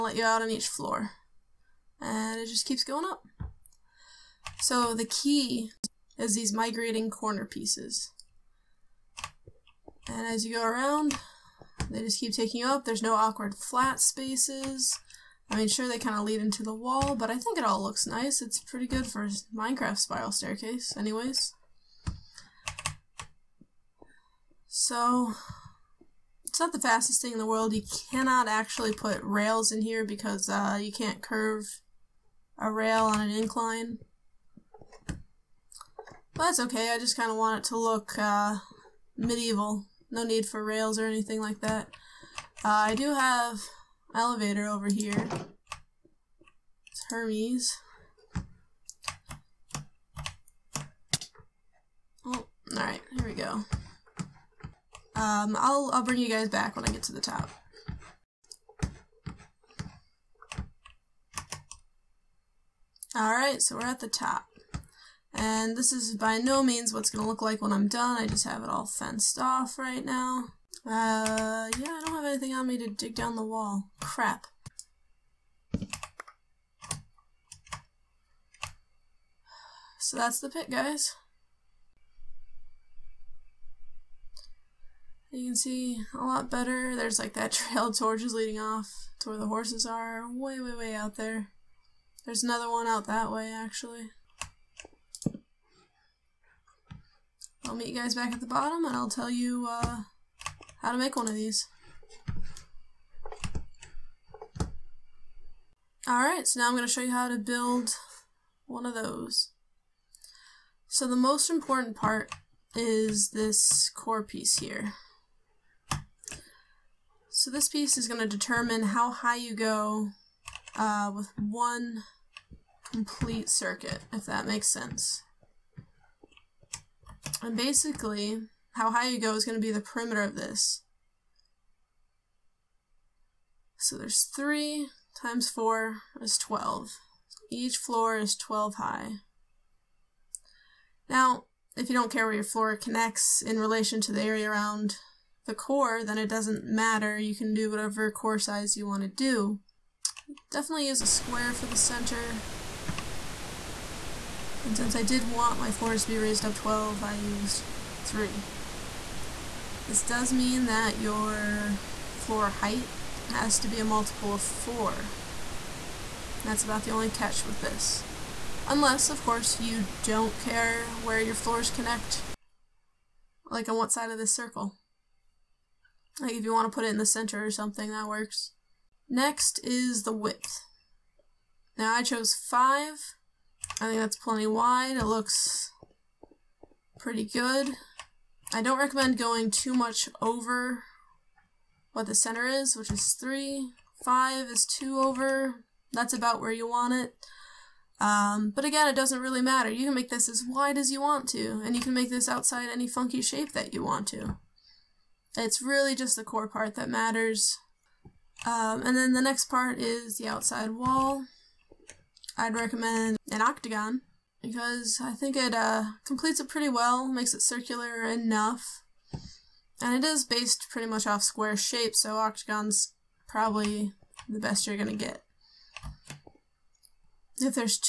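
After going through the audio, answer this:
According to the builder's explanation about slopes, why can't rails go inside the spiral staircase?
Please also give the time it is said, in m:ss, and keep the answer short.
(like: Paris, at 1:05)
can't curve a rail on an incline, at 0:30.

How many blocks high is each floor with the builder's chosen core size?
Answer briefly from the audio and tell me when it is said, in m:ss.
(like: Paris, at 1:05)
12, at 2:17.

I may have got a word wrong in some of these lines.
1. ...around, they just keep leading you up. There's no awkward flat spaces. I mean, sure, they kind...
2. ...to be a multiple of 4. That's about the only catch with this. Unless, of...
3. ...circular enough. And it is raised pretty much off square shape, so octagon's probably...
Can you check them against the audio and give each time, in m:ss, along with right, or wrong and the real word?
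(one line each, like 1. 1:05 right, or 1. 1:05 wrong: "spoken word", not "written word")
1. 0:10 wrong: "taking", not "leading"
2. 2:43 right
3. 3:37 wrong: "based", not "raised".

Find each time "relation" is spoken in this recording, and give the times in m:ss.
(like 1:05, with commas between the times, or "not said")
2:23.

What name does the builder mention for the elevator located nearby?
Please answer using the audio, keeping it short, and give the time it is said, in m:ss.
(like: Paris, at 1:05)
Hermes, at 0:47.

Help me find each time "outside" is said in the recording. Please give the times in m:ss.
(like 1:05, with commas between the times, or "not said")
3:22, 3:30.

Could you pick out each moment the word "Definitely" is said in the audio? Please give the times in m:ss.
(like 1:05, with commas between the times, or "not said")
2:30.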